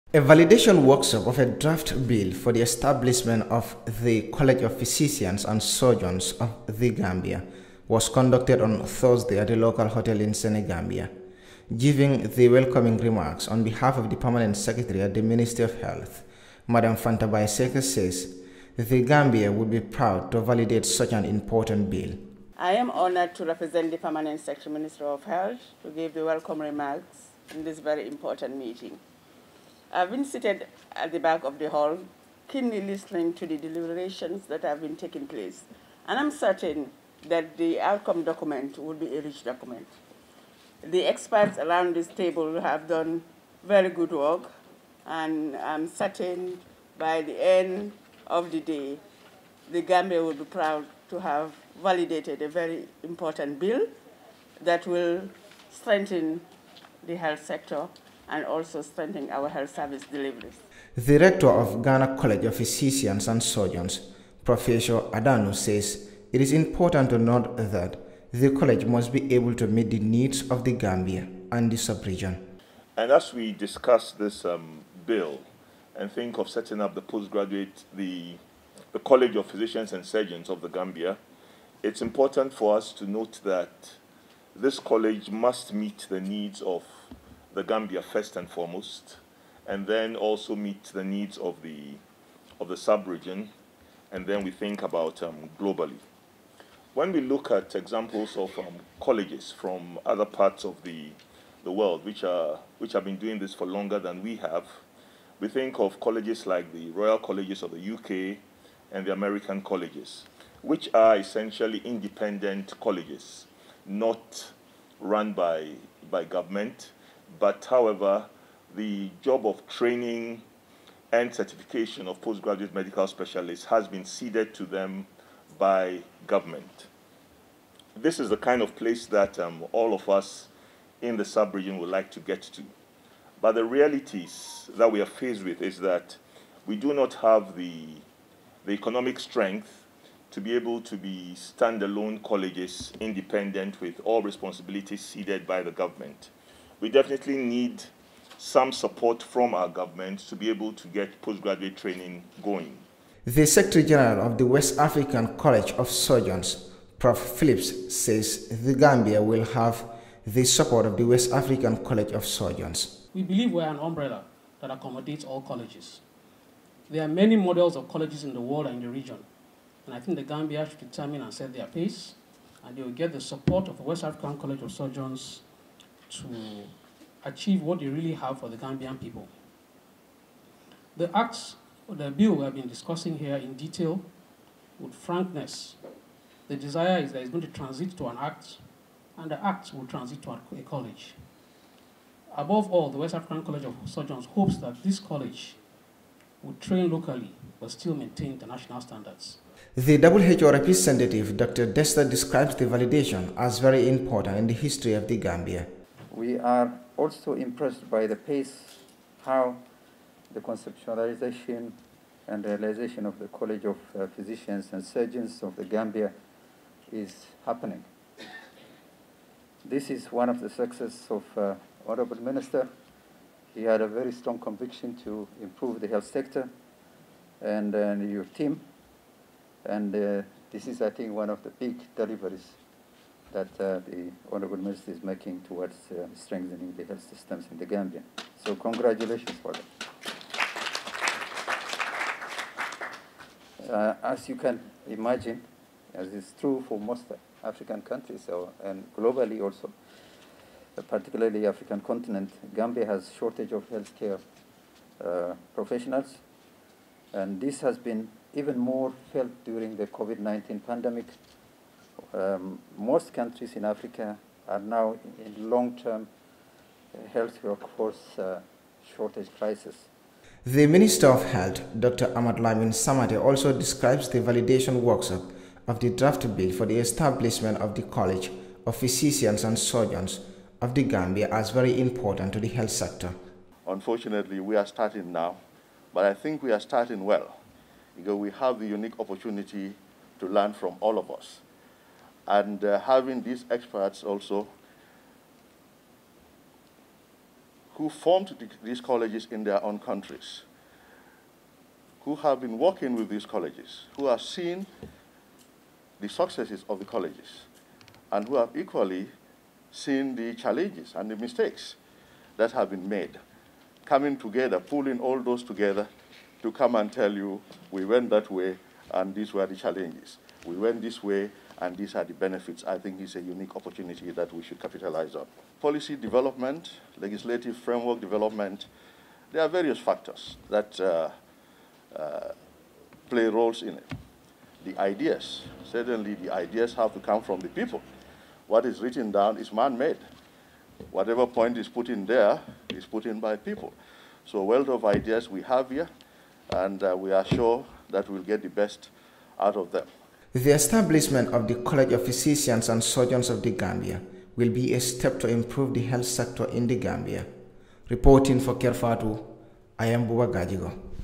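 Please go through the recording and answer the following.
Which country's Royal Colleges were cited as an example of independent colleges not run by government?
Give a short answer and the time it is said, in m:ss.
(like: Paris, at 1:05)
UK, at 1:47.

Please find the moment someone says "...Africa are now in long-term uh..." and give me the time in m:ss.
4:23.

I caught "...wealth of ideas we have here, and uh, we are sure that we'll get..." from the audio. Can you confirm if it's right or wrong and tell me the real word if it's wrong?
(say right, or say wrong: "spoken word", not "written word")
right.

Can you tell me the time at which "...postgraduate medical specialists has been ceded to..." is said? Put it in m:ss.
2:02.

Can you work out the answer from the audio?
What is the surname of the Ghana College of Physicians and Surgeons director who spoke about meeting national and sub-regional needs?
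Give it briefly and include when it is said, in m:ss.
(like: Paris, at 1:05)
Adano, at 1:05.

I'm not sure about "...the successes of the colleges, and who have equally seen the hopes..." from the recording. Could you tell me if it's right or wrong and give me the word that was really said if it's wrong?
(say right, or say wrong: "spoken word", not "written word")
wrong: "challenges", not "hopes".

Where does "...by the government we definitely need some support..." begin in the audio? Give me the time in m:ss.
2:25.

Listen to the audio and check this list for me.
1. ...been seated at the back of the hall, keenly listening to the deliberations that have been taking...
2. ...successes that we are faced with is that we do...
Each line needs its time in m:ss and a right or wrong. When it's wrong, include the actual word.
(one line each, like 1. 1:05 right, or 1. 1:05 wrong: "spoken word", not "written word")
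1. 0:30 right
2. 2:13 wrong: "realities", not "successes".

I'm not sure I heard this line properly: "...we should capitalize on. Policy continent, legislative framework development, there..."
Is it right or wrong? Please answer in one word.
wrong.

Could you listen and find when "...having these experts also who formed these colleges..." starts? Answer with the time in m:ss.
4:52.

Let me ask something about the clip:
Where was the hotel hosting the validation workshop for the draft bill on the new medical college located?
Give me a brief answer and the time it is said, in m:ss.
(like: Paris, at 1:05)
Senegambia, at 0:10.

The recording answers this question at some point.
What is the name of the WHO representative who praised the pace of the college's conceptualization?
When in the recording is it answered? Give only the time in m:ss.
3:21.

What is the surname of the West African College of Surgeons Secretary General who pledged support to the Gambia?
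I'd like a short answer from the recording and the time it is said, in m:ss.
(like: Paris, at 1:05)
Phillips, at 2:37.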